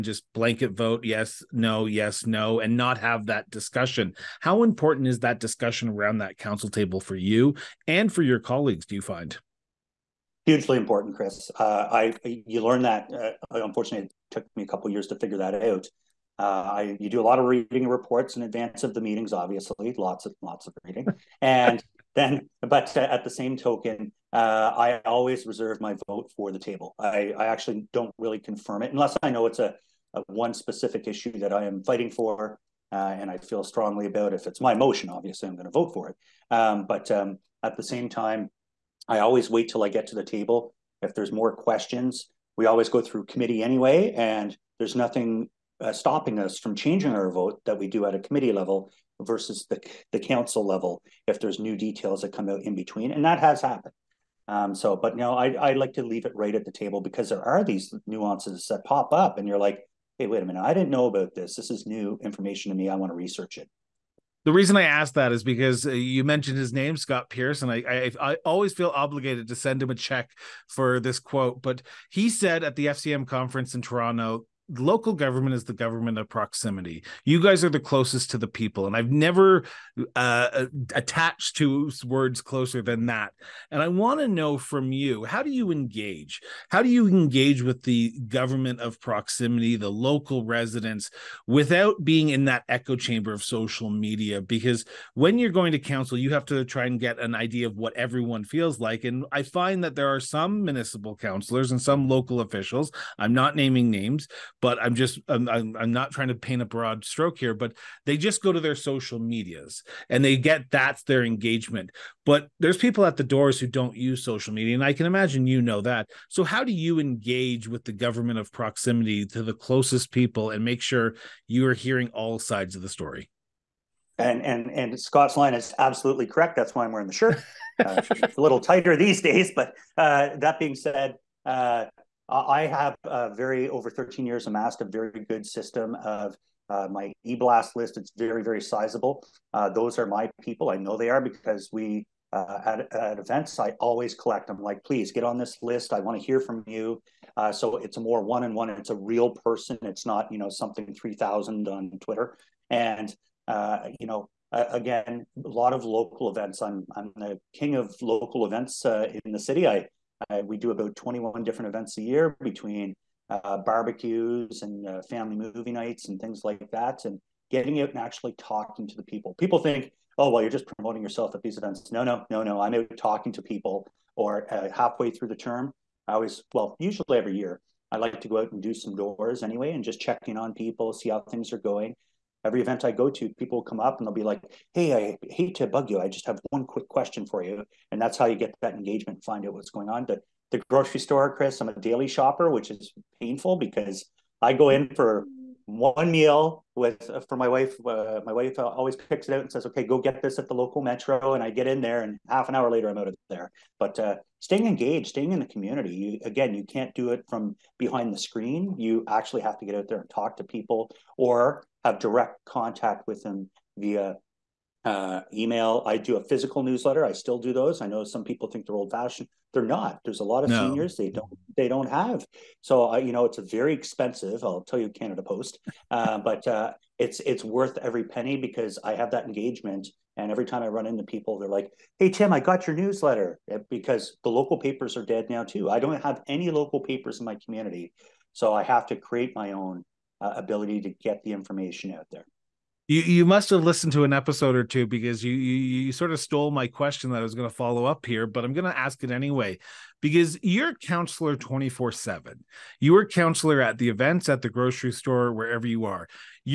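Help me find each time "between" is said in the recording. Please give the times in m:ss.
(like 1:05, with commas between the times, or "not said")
0:52, 2:42.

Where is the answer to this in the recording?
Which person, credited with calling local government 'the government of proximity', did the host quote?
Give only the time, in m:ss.
1:06.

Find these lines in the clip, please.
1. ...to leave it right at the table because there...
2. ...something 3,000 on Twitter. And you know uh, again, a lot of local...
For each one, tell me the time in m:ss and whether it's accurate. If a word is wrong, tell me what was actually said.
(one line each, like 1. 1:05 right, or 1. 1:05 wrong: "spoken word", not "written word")
1. 0:55 right
2. 2:30 right.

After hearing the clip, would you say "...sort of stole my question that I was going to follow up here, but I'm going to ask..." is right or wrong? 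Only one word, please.
right.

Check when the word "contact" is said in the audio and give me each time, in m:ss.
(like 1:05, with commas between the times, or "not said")
3:32.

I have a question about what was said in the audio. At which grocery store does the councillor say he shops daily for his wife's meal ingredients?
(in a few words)
Metro.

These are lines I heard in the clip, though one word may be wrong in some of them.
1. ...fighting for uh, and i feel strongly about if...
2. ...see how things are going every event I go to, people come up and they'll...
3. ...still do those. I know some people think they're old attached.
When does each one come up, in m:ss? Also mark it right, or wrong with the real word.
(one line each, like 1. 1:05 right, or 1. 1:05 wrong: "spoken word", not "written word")
1. 0:31 right
2. 3:00 right
3. 3:37 wrong: "fashioned", not "attached".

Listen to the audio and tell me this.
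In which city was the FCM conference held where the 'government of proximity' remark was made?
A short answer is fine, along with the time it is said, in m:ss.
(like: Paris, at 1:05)
Toronto, at 1:13.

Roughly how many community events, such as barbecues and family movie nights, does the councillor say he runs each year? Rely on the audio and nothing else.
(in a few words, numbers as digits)
21.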